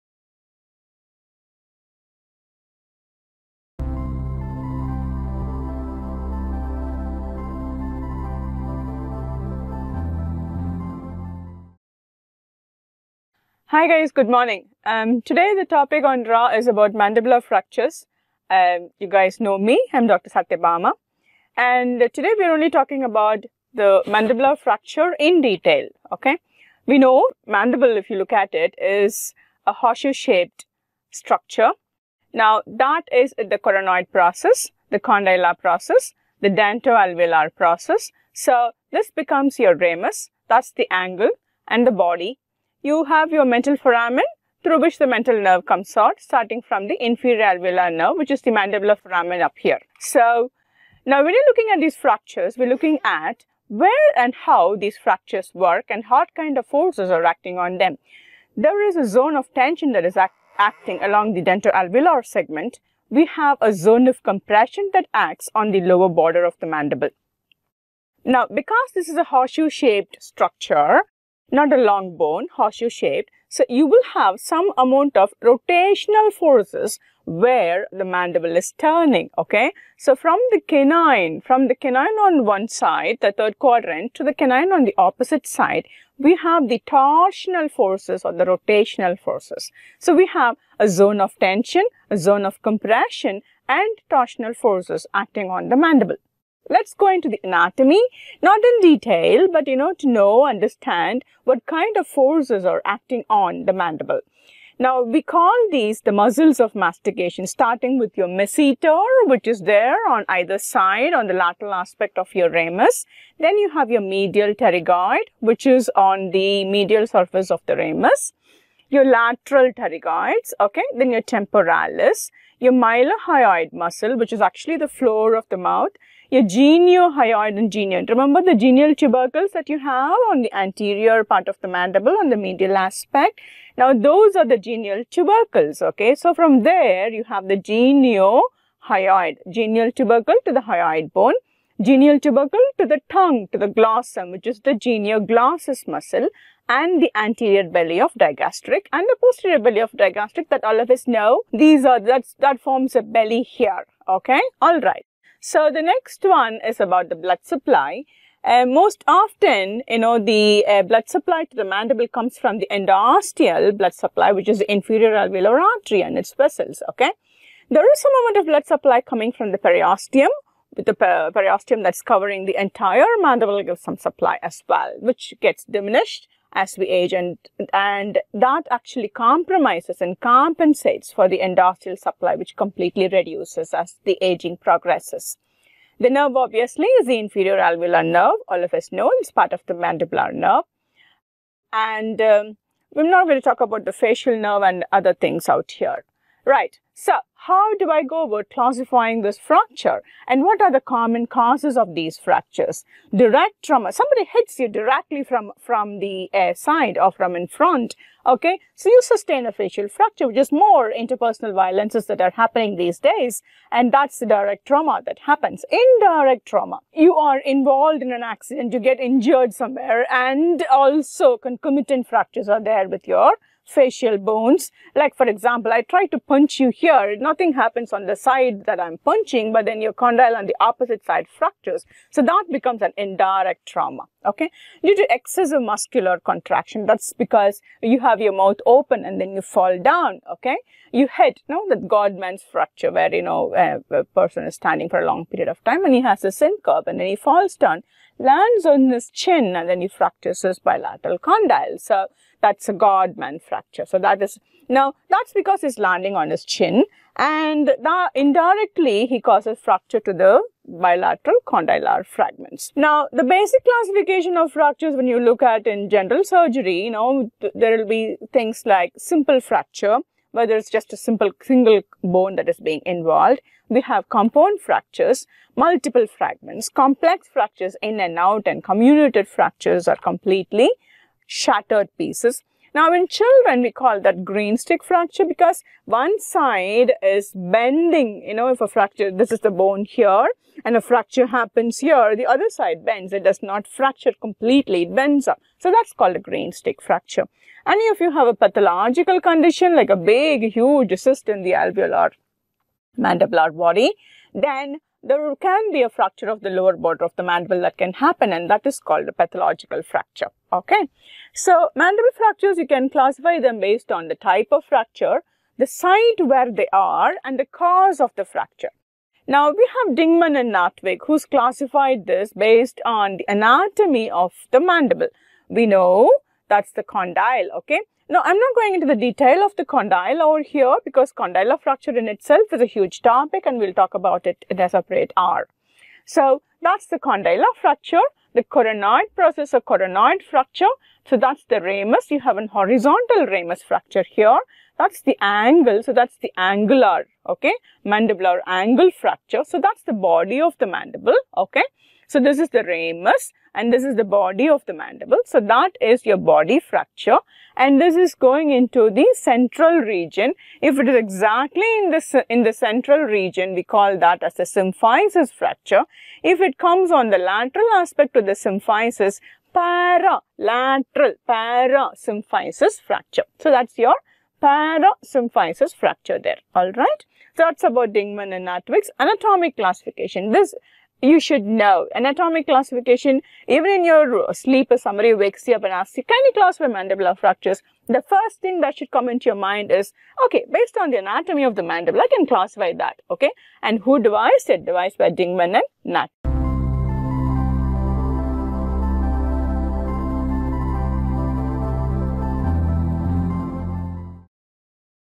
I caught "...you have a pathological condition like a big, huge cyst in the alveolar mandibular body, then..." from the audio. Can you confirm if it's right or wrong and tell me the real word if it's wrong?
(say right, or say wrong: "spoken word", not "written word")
right.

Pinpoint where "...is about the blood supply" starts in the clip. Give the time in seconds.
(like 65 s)
156 s.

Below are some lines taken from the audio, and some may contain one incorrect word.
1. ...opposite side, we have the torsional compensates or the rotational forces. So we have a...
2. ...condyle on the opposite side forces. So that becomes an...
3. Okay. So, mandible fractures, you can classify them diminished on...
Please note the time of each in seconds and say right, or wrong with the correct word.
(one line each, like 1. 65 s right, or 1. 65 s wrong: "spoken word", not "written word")
1. 84 s wrong: "forces", not "compensates"
2. 229 s wrong: "fractures", not "forces"
3. 310 s wrong: "based", not "diminished".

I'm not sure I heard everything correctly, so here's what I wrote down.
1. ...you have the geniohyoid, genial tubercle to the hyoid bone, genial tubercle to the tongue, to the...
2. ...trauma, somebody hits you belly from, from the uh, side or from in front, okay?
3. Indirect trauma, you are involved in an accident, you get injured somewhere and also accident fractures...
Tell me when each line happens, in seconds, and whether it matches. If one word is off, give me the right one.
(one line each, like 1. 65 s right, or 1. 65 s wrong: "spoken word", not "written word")
1. 137 s right
2. 203 s wrong: "directly", not "belly"
3. 215 s wrong: "concomitant", not "accident".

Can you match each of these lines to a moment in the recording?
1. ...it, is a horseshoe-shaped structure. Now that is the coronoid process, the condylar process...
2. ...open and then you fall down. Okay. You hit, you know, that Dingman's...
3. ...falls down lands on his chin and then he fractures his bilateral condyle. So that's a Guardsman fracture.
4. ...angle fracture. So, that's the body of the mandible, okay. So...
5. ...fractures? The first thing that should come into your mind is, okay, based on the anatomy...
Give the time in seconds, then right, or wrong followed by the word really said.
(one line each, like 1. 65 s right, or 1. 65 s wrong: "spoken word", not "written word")
1. 28 s right
2. 238 s wrong: "Guardsman", not "Dingman"
3. 247 s right
4. 348 s right
5. 387 s right.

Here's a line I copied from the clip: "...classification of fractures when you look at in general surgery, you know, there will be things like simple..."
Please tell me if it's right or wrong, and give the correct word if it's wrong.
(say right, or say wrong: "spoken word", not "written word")
right.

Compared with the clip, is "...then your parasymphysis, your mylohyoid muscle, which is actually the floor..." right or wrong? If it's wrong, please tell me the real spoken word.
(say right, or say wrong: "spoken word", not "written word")
wrong: "temporalis", not "parasymphysis".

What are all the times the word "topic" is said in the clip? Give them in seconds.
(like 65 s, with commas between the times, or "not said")
15 s, 333 s.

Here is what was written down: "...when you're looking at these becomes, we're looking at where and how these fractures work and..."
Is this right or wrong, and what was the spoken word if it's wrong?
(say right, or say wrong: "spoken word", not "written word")
wrong: "fractures", not "becomes".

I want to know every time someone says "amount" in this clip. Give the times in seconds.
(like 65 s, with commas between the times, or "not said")
74 s, 168 s.